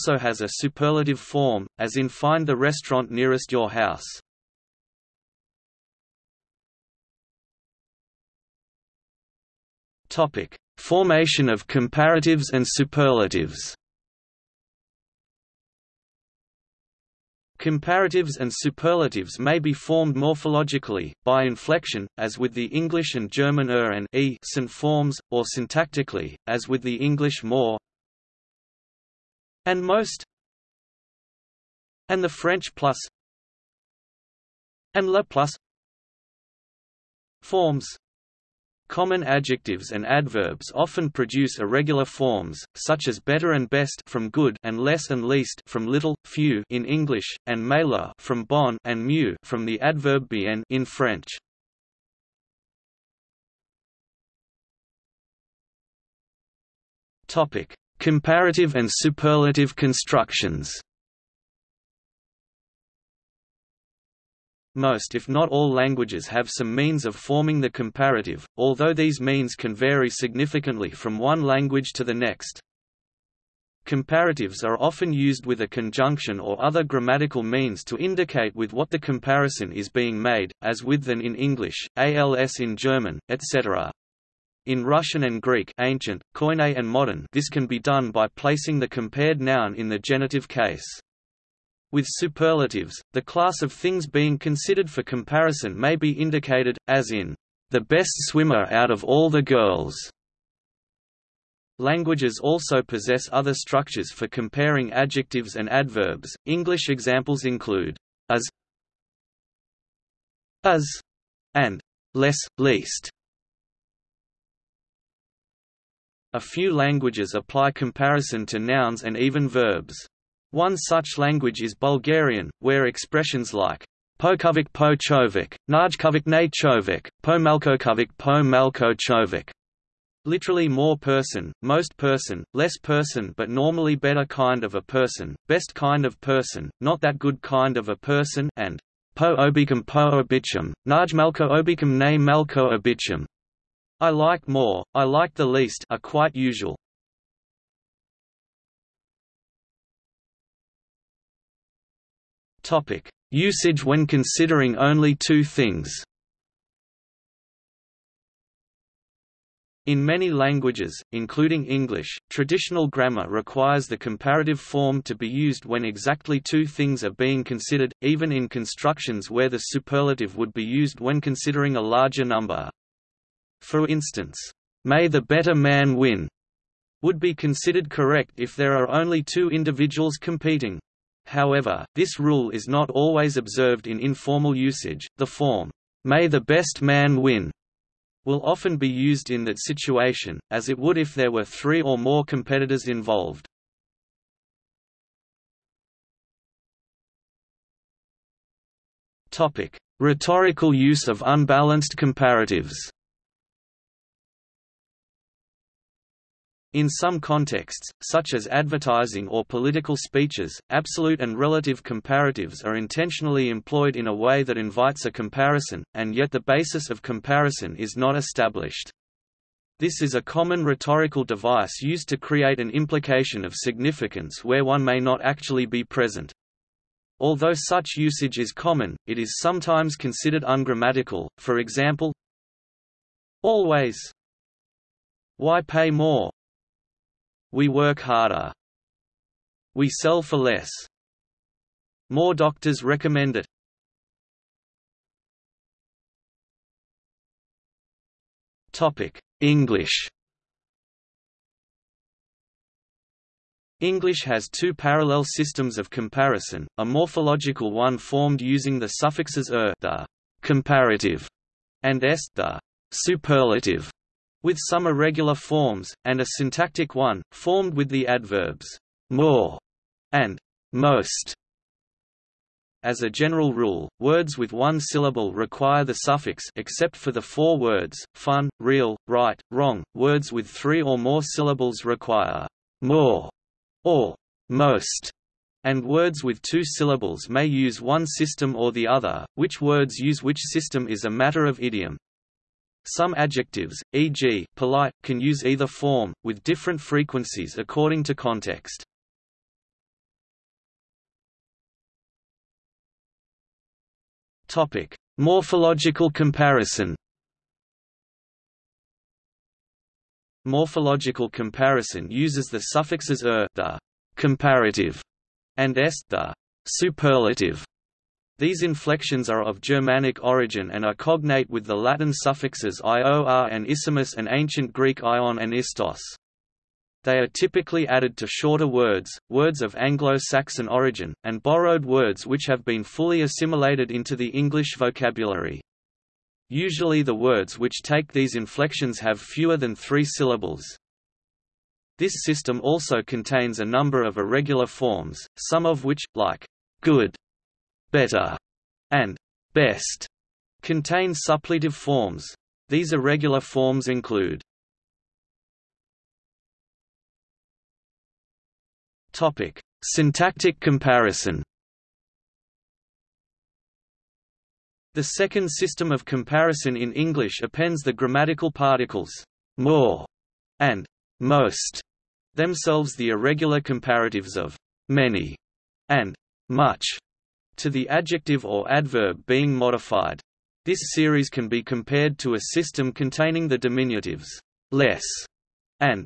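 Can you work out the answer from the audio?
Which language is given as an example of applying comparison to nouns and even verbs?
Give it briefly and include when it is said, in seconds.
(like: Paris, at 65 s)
Bulgarian, at 121 s.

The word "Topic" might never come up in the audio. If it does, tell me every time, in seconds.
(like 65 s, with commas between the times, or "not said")
10 s, 57 s, 152 s, 248 s, 304 s, 359 s.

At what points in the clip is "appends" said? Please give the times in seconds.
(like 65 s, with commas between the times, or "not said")
367 s.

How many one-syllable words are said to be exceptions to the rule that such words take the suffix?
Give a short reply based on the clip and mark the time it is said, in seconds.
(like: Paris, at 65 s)
4, at 277 s.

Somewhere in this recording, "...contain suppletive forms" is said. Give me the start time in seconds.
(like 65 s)
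350 s.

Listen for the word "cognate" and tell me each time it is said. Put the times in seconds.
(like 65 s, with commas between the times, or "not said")
320 s.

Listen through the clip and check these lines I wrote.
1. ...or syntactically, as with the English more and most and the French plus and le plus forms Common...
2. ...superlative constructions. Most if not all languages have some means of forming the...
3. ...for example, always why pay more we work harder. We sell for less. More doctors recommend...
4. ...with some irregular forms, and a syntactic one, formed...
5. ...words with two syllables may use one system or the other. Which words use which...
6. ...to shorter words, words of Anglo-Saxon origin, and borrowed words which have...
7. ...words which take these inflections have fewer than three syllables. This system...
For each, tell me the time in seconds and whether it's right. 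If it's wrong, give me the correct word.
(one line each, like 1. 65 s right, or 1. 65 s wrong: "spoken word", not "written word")
1. 25 s right
2. 58 s right
3. 231 s right
4. 264 s right
5. 285 s right
6. 328 s right
7. 337 s right.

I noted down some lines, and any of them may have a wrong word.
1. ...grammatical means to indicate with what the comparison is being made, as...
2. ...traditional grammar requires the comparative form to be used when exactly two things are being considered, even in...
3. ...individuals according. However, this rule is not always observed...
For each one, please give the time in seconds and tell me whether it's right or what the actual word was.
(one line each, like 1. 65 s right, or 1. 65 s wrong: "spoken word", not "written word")
1. 76 s right
2. 162 s right
3. 179 s wrong: "competing", not "according".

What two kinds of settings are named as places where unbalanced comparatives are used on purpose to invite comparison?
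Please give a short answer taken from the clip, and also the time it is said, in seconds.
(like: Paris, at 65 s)
advertising or political speeches, at 208 s.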